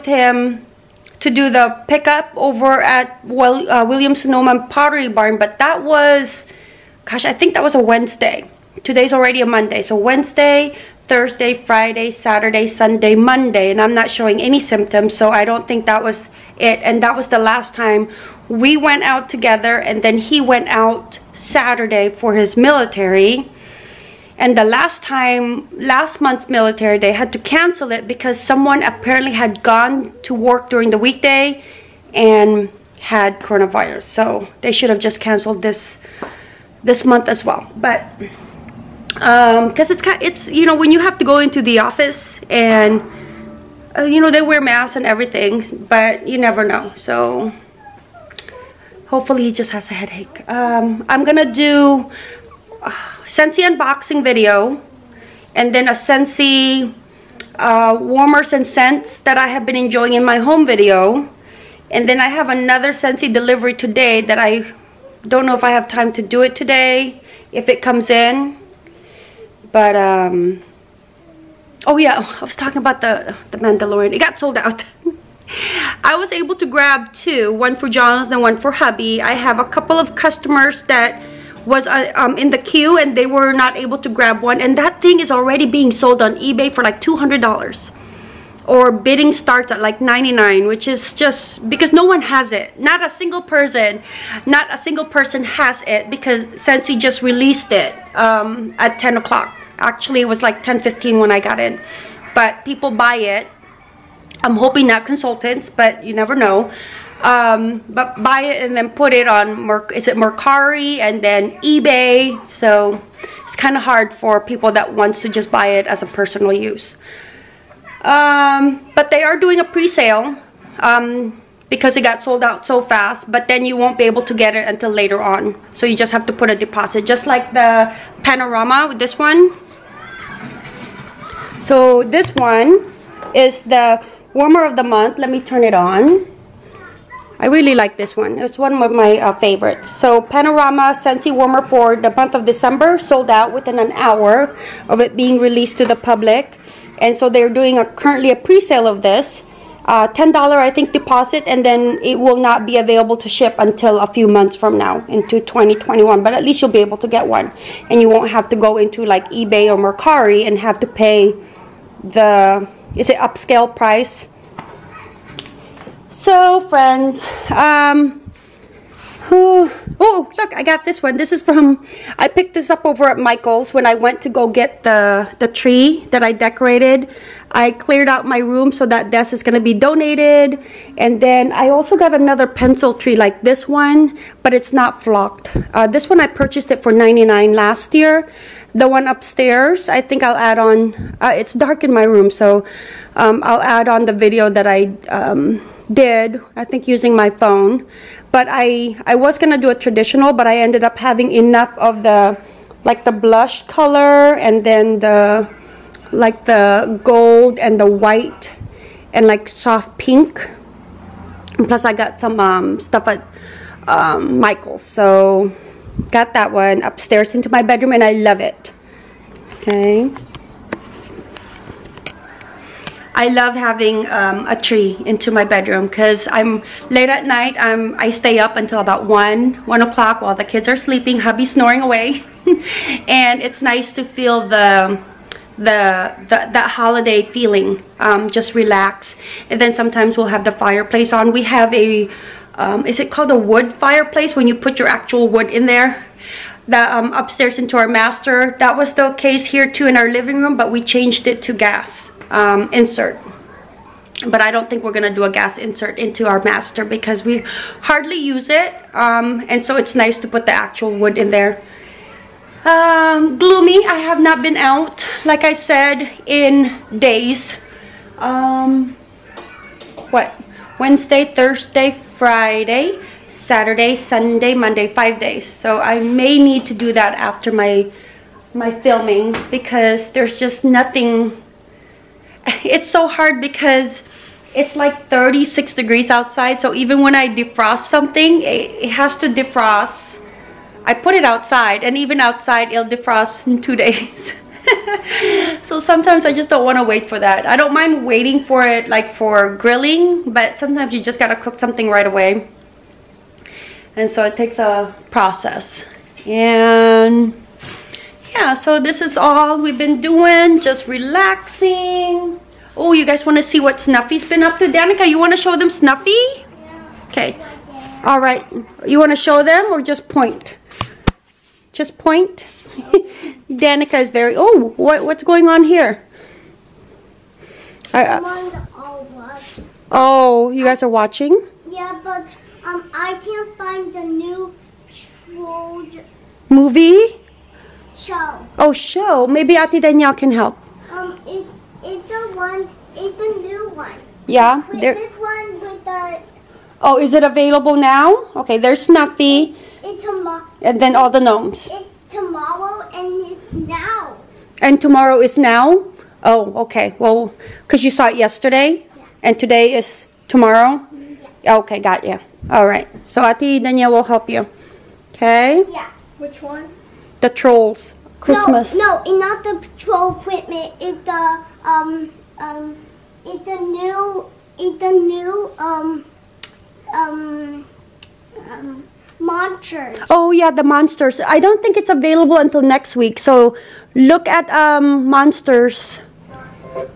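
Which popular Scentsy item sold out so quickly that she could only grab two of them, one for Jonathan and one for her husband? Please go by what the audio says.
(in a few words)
The Mandalorian.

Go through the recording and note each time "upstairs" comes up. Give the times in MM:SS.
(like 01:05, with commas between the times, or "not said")
03:09, 03:36, 04:07.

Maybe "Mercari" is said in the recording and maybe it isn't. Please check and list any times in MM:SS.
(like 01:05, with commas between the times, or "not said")
01:50, 02:39.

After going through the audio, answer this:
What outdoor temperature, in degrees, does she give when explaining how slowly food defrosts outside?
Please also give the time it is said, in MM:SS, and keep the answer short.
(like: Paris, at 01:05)
36, at 04:45.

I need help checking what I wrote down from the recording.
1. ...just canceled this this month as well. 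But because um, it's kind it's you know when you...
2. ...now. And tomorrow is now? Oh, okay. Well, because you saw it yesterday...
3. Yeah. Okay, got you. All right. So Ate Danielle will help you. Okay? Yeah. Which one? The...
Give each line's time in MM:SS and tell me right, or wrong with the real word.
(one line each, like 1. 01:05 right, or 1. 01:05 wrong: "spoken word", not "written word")
1. 00:34 right
2. 05:53 right
3. 06:01 right.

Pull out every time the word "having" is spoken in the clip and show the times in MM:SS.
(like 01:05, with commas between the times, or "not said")
03:20, 03:43.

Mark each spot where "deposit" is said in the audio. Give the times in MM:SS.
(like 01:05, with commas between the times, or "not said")
02:06, 02:30.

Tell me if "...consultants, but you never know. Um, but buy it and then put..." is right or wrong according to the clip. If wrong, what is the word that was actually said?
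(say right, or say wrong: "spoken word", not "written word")
right.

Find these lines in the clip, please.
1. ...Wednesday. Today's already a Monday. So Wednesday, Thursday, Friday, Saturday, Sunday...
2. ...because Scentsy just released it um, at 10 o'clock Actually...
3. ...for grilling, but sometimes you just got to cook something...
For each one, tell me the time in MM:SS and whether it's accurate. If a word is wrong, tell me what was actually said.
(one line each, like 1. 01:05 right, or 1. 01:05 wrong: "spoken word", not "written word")
1. 00:07 right
2. 01:36 right
3. 04:59 right.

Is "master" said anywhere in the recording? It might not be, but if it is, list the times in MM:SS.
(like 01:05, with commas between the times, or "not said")
04:07, 04:16.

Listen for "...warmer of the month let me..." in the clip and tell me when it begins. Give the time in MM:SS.
02:14.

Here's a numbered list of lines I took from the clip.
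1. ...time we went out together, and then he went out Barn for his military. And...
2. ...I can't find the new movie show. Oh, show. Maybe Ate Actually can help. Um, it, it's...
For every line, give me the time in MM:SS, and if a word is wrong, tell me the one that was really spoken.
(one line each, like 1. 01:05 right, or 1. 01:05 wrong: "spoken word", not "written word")
1. 00:17 wrong: "Saturday", not "Barn"
2. 05:32 wrong: "Danielle", not "Actually".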